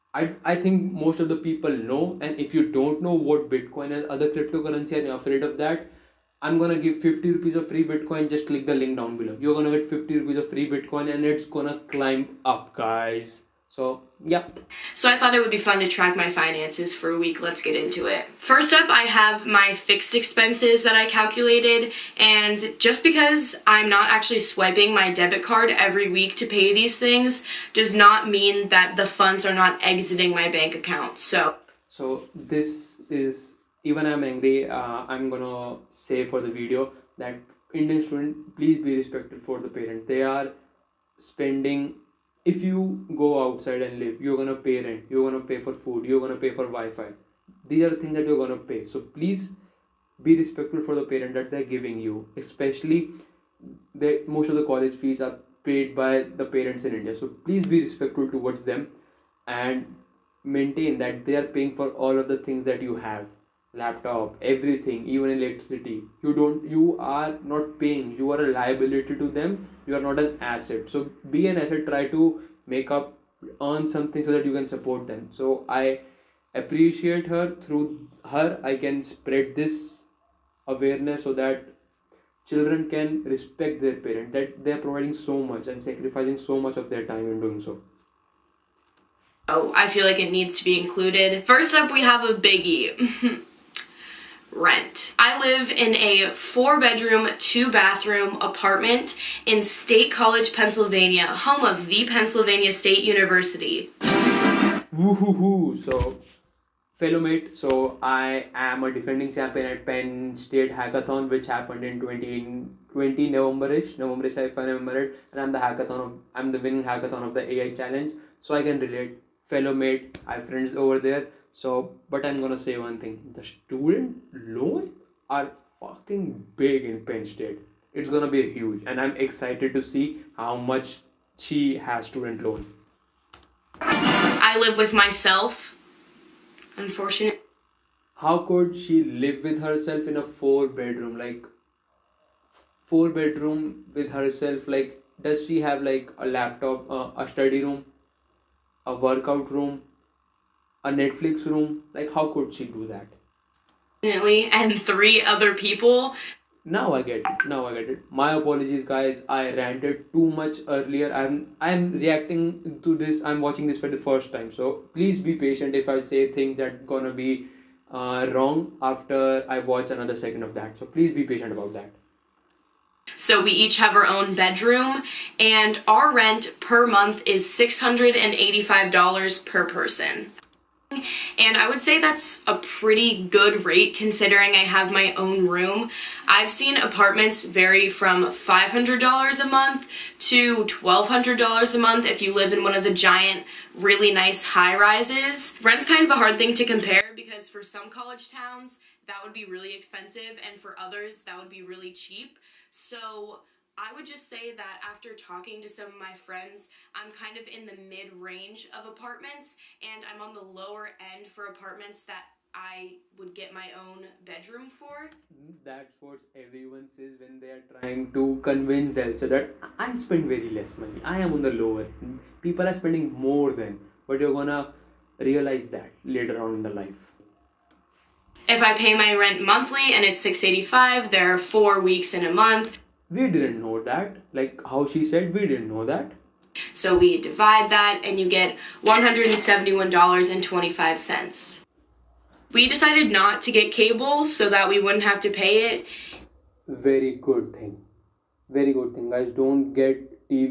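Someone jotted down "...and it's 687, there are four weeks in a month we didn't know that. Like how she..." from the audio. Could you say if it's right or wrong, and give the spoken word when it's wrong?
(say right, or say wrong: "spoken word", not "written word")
wrong: "685", not "687".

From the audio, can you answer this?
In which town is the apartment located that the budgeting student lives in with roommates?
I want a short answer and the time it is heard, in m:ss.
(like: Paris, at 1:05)
State College, Pennsylvania, at 1:39.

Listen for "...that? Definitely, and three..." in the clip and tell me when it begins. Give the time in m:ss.
2:32.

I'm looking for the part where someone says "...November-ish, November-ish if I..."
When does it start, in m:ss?
1:53.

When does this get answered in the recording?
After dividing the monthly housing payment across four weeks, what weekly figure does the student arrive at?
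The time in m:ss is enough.
3:58.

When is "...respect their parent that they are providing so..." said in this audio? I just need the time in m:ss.
1:23.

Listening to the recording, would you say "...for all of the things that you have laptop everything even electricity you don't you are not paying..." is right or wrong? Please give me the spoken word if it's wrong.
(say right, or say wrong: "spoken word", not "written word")
right.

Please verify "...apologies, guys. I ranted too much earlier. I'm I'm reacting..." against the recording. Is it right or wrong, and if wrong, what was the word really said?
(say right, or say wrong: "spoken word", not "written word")
right.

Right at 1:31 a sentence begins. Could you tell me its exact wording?
First up, we have a biggie.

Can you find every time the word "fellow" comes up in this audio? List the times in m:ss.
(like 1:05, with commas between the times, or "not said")
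1:46, 1:59.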